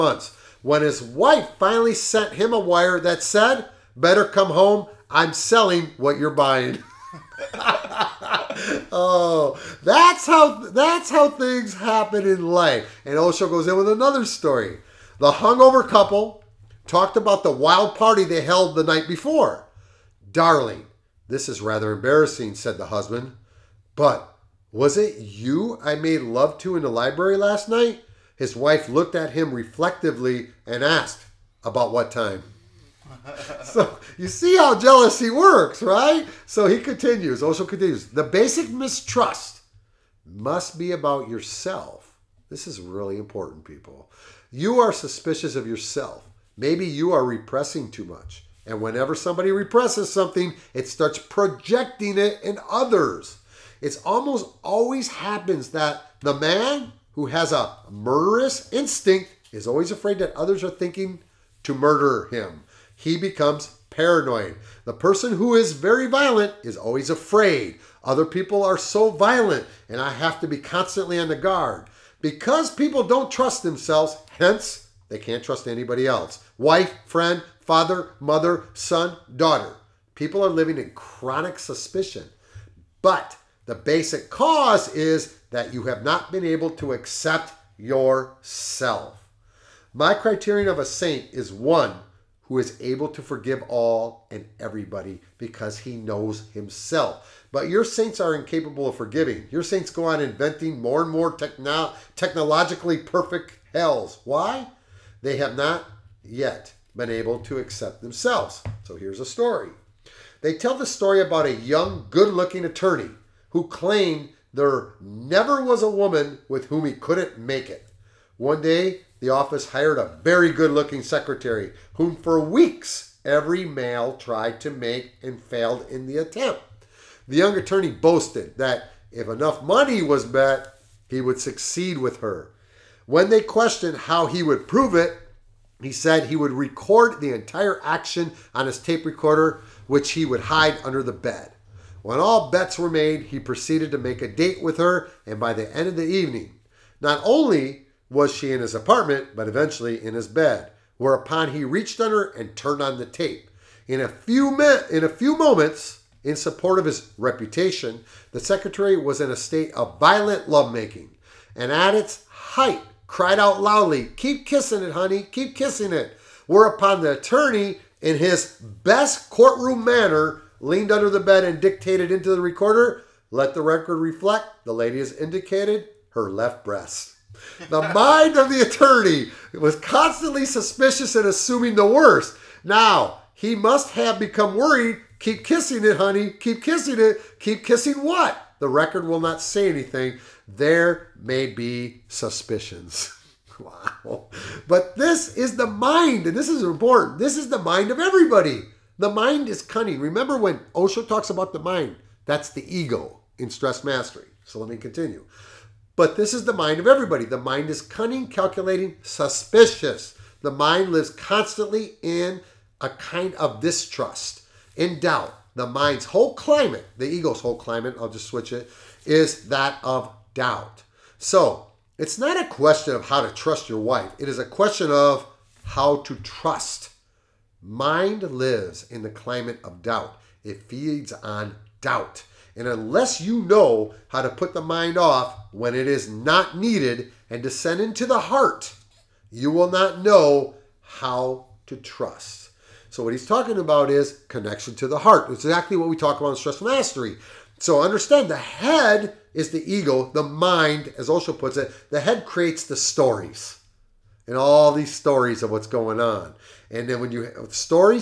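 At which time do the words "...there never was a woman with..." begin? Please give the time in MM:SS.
01:54.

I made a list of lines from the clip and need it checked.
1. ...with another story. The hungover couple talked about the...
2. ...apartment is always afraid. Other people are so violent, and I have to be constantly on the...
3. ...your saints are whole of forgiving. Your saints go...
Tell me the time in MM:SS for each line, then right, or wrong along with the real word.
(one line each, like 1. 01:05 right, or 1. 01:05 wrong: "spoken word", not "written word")
1. 00:13 right
2. 01:06 wrong: "violent", not "apartment"
3. 01:37 wrong: "incapable", not "whole".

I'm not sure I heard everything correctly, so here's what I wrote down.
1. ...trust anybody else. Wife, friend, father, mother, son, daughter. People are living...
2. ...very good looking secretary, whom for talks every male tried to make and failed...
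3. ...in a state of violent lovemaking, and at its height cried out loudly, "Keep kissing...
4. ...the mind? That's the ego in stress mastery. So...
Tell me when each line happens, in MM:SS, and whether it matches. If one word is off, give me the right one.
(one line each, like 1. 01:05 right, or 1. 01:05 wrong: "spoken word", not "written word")
1. 01:15 right
2. 02:00 wrong: "weeks", not "talks"
3. 02:39 right
4. 03:21 right.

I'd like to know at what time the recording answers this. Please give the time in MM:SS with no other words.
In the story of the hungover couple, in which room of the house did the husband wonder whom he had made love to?
00:26.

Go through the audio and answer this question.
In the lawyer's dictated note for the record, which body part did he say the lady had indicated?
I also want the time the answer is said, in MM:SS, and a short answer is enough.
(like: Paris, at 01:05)
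left breast, at 02:56.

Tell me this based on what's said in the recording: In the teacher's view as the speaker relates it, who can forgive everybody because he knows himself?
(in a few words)
a saint.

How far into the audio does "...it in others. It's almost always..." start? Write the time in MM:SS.
00:52.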